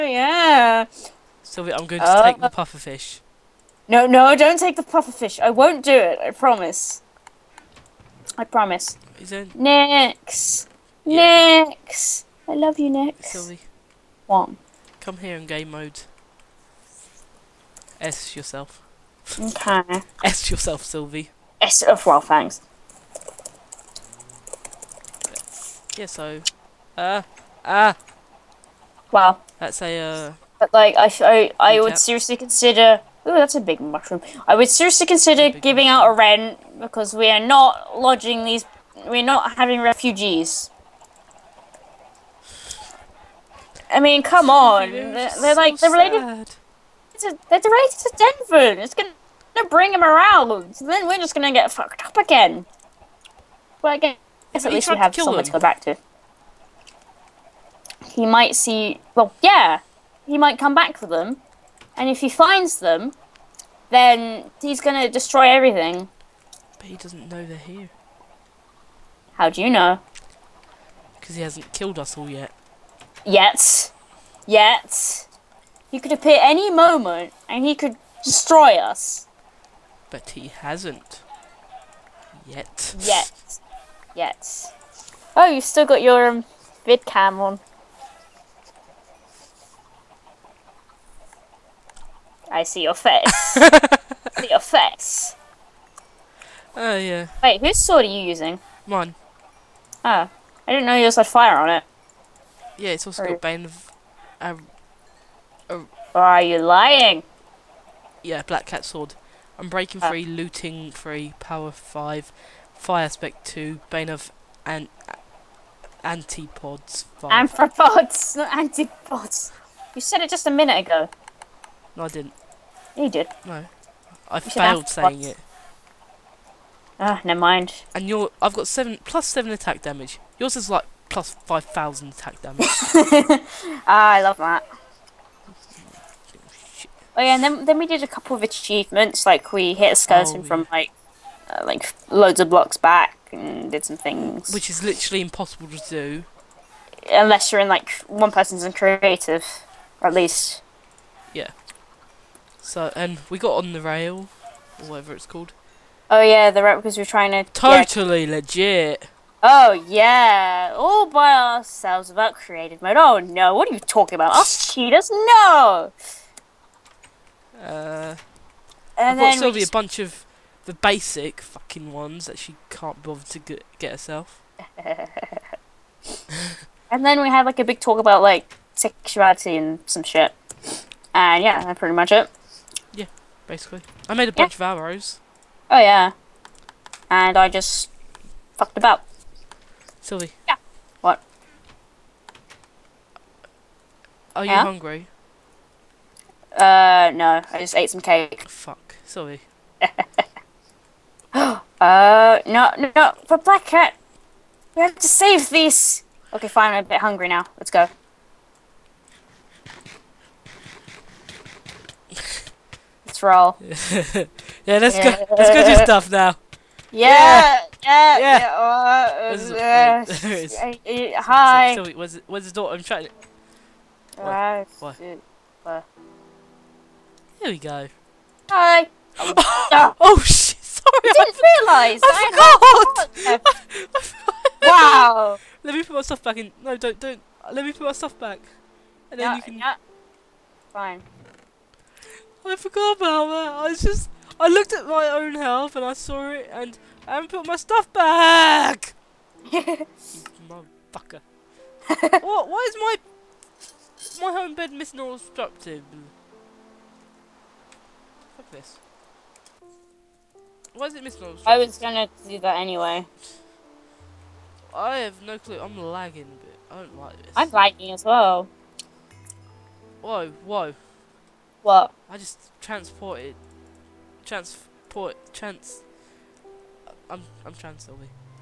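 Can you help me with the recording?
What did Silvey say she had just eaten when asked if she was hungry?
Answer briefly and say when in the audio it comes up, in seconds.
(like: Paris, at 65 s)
Cake, at 198 s.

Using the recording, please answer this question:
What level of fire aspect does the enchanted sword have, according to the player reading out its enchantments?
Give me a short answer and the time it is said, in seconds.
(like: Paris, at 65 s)
2, at 112 s.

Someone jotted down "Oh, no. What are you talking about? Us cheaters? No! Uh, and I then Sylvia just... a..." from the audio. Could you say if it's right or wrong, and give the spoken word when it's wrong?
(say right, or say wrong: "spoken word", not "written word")
right.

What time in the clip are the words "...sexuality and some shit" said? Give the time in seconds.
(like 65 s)
178 s.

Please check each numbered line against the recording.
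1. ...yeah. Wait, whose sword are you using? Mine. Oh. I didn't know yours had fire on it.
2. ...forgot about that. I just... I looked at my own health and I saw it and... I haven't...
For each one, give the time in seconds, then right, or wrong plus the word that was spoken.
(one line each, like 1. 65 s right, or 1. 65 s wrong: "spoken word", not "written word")
1. 96 s right
2. 242 s right.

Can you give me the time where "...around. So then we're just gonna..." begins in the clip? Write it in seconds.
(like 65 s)
50 s.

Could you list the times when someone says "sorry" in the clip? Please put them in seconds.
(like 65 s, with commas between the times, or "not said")
221 s, 230 s.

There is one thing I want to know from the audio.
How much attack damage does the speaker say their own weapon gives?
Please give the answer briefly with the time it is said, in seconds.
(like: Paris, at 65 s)
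7 plus 7, at 128 s.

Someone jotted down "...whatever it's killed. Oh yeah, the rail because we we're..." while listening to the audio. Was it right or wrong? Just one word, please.
wrong.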